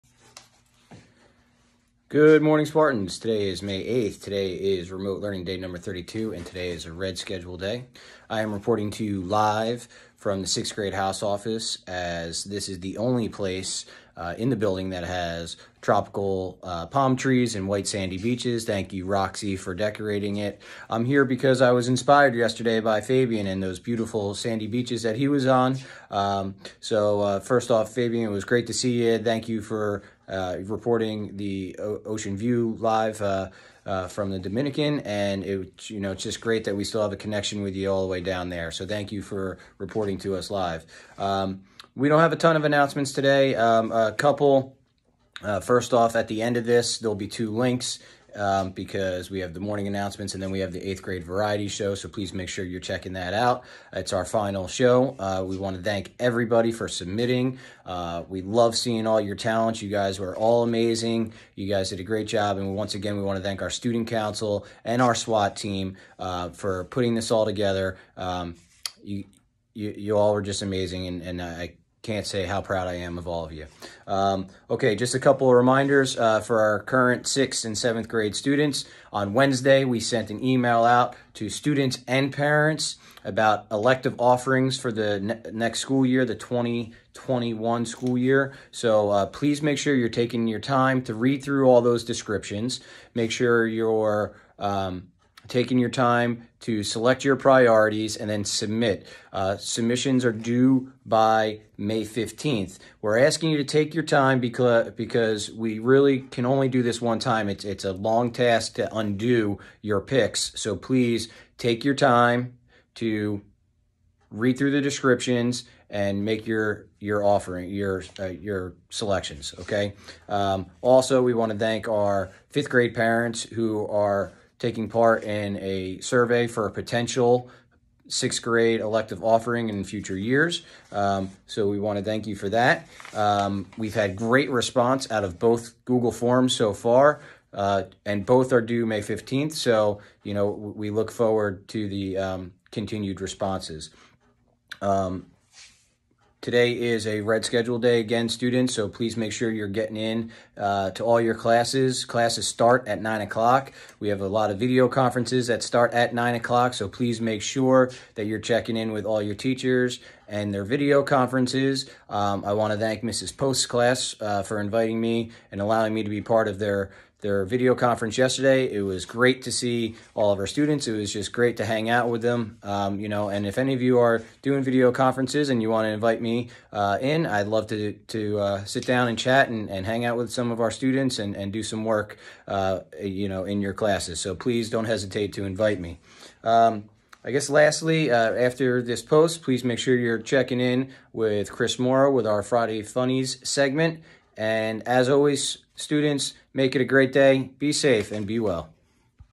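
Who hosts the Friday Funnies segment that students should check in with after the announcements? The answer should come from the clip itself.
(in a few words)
Chris Morrow.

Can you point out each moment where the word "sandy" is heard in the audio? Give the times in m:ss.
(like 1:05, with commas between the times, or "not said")
0:17, 0:24.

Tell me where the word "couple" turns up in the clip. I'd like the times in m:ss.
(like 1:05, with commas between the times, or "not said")
0:44, 1:15.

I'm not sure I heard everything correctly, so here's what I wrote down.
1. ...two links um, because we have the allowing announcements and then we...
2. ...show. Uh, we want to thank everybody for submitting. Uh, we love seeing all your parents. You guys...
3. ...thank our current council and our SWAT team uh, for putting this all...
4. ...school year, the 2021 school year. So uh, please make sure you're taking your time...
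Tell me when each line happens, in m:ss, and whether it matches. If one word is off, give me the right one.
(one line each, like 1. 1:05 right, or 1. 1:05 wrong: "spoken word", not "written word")
1. 0:47 wrong: "morning", not "allowing"
2. 0:54 wrong: "talents", not "parents"
3. 1:03 wrong: "student", not "current"
4. 1:25 right.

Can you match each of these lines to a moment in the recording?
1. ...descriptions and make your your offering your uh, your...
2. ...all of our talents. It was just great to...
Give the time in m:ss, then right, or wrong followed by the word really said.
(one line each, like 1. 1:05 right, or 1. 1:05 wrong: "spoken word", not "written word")
1. 1:54 right
2. 2:50 wrong: "students", not "talents".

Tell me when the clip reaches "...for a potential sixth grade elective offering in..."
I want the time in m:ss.
2:06.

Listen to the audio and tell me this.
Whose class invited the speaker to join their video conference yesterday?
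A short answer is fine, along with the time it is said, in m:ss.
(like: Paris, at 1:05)
Mrs. Post's class, at 2:43.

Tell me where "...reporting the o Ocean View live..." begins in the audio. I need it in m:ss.
0:30.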